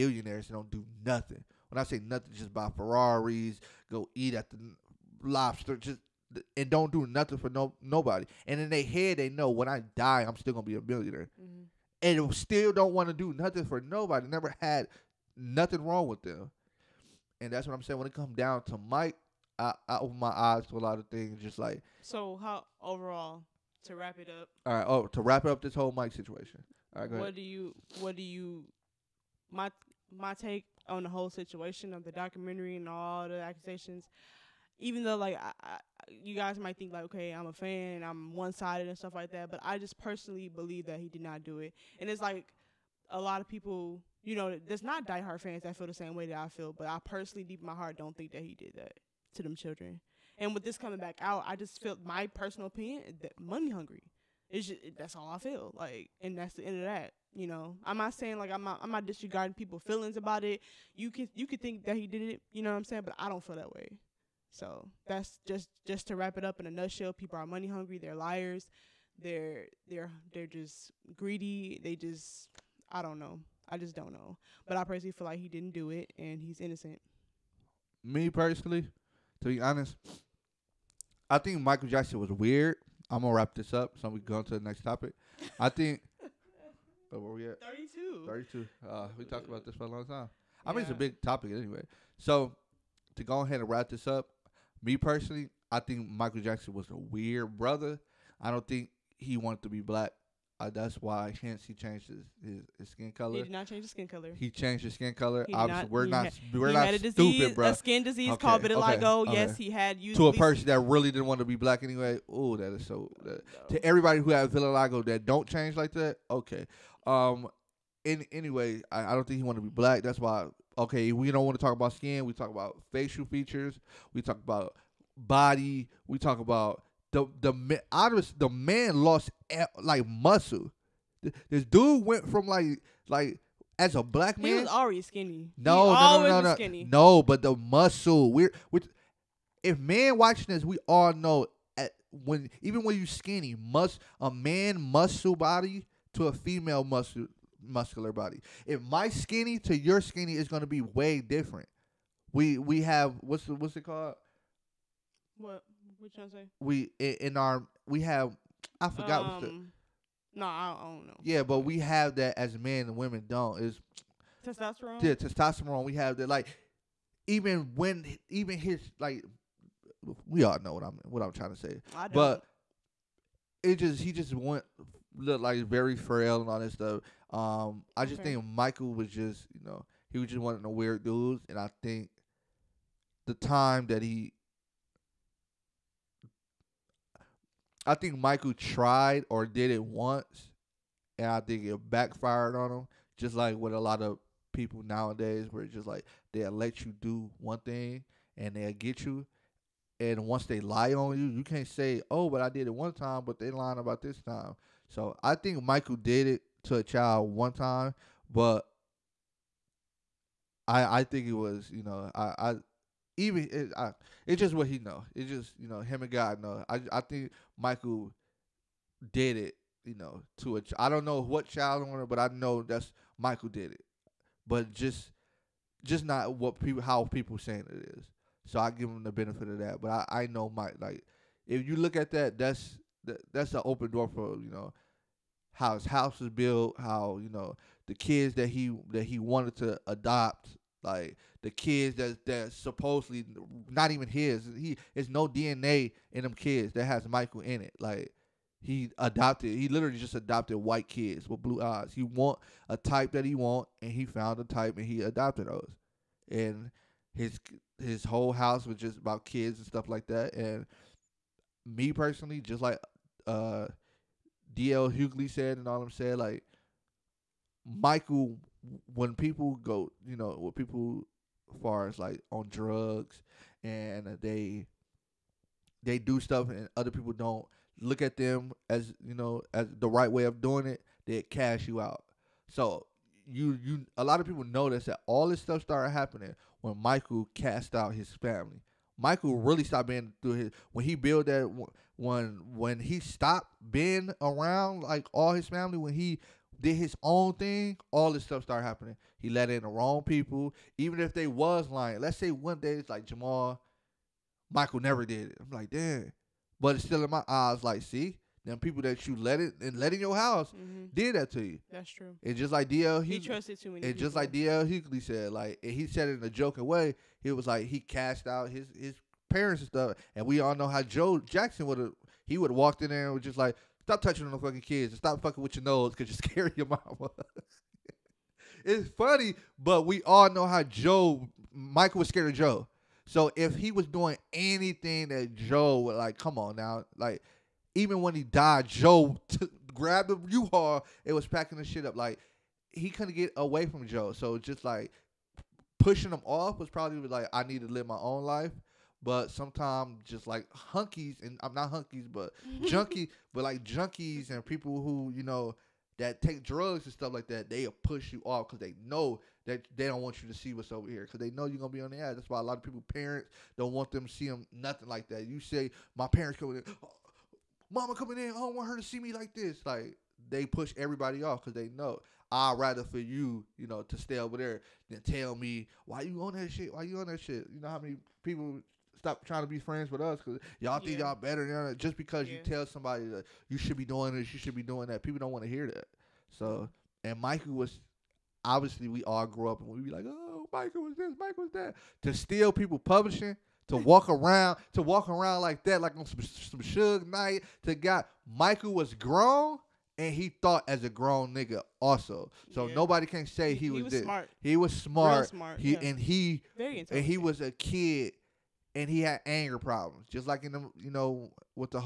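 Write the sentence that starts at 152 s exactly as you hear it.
We we have what's the, what's it called?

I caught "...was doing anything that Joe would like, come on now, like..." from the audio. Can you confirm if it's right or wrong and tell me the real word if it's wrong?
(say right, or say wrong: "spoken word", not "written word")
right.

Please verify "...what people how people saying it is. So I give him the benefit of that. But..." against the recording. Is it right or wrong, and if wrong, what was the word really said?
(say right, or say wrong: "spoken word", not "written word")
right.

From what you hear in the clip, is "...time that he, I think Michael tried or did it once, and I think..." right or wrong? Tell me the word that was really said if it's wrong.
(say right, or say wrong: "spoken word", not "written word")
right.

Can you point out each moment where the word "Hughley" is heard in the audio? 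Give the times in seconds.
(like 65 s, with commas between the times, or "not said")
264 s, 314 s.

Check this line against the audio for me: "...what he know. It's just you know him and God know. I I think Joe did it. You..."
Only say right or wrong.
wrong.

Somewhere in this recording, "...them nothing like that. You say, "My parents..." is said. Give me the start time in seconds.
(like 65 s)
364 s.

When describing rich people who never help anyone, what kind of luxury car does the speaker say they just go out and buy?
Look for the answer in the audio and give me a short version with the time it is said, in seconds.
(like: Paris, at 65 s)
Ferraris, at 2 s.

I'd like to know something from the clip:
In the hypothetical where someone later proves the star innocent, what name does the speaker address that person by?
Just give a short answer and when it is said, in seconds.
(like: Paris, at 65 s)
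Jamal, at 303 s.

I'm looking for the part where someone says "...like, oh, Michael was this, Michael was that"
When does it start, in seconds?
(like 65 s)
389 s.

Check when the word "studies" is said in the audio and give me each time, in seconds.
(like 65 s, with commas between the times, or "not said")
not said.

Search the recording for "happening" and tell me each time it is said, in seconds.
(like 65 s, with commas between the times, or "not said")
285 s, 298 s.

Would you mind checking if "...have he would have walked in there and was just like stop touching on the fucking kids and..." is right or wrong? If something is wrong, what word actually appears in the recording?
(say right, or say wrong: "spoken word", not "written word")
right.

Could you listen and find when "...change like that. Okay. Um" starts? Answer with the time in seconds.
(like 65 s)
115 s.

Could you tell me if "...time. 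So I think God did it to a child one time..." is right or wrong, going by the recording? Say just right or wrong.
wrong.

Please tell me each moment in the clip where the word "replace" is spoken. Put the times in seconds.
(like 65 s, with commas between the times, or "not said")
not said.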